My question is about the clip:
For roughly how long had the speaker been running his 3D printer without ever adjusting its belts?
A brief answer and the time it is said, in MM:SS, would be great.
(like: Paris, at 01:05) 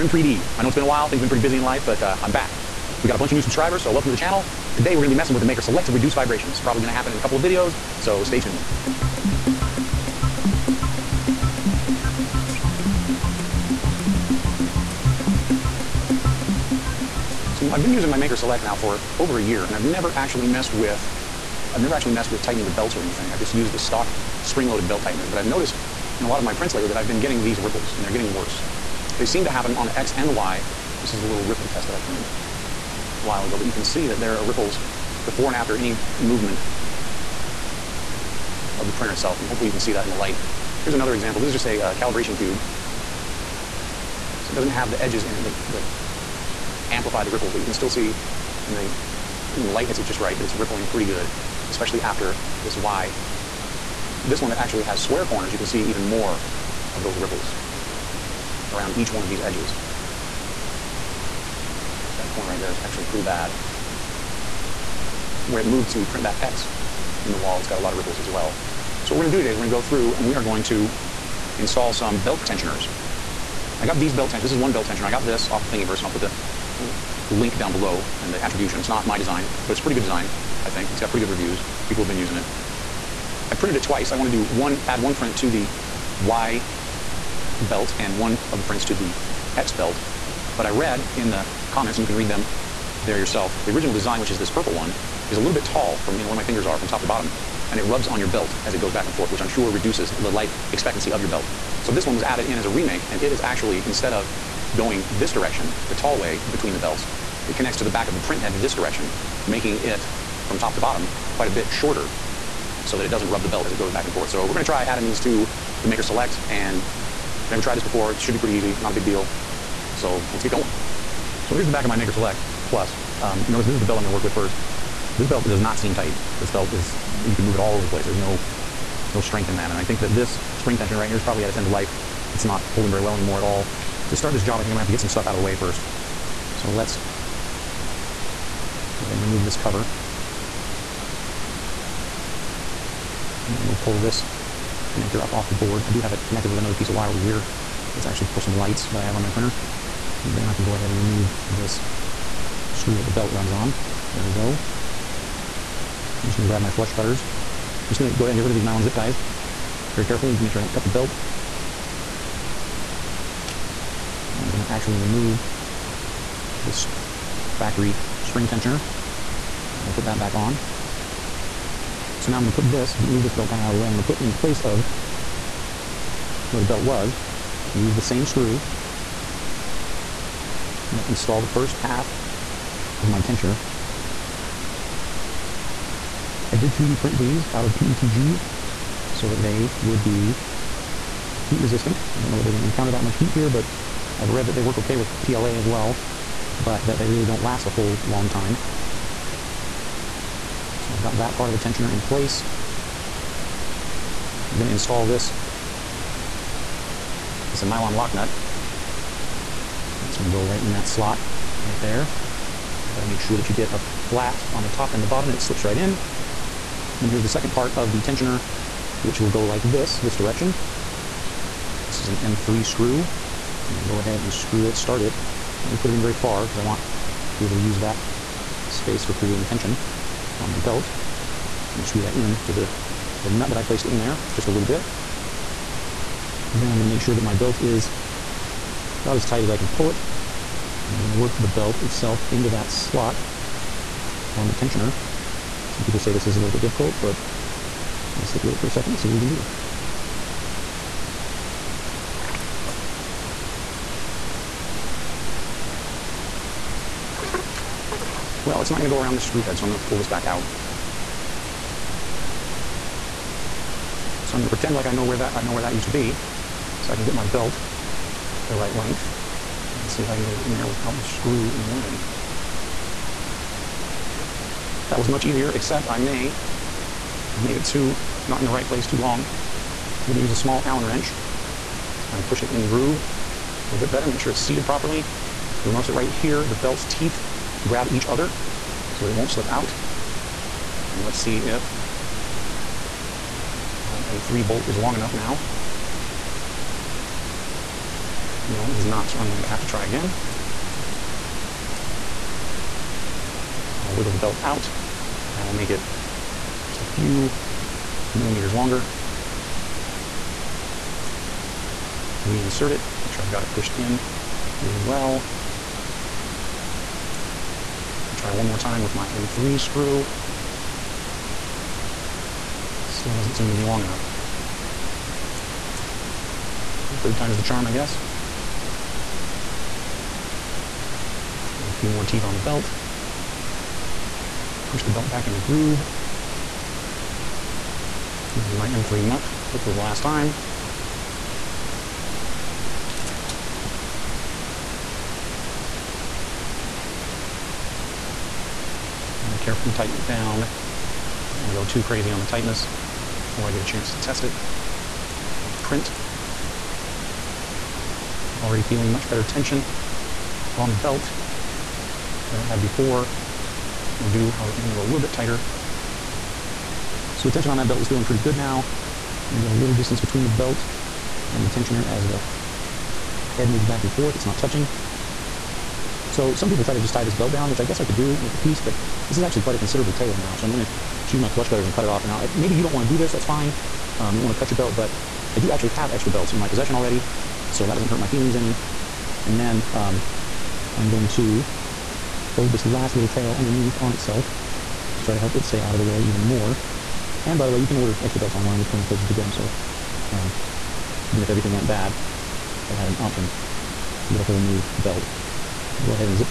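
over a year, at 00:19.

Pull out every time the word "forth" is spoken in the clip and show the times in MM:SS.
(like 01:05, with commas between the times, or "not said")
01:39, 01:54, 06:13.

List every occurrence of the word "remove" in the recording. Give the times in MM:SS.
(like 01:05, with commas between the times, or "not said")
02:19, 02:30, 02:44.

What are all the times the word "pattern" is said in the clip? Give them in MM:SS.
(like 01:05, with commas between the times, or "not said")
not said.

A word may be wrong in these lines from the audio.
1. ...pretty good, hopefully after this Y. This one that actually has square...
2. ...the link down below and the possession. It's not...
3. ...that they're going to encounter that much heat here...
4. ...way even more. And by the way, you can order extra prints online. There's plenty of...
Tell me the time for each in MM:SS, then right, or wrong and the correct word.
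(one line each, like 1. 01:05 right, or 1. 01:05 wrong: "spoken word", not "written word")
1. 00:50 wrong: "especially", not "hopefully"
2. 01:16 wrong: "attribution", not "possession"
3. 03:12 right
4. 06:35 wrong: "belts", not "prints".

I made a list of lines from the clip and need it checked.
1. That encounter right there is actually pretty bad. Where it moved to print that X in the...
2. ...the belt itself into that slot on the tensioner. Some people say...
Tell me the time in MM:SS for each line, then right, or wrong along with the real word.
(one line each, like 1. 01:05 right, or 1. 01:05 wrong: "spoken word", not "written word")
1. 01:02 wrong: "corner", not "encounter"
2. 04:01 right.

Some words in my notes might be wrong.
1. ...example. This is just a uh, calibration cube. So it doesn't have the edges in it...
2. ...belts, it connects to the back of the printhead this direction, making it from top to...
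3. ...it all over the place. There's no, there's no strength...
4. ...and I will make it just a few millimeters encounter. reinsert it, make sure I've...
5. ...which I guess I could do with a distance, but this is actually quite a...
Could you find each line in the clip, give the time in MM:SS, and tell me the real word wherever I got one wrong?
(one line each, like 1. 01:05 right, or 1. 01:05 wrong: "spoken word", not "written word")
1. 00:41 right
2. 01:46 right
3. 02:07 right
4. 05:05 wrong: "longer", not "encounter"
5. 06:17 wrong: "piece", not "distance".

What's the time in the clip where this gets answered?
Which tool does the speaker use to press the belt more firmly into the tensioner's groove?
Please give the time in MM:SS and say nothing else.
04:40.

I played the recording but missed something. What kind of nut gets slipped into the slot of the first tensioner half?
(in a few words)
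nylon lock nut.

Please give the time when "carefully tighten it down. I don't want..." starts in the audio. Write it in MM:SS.
05:49.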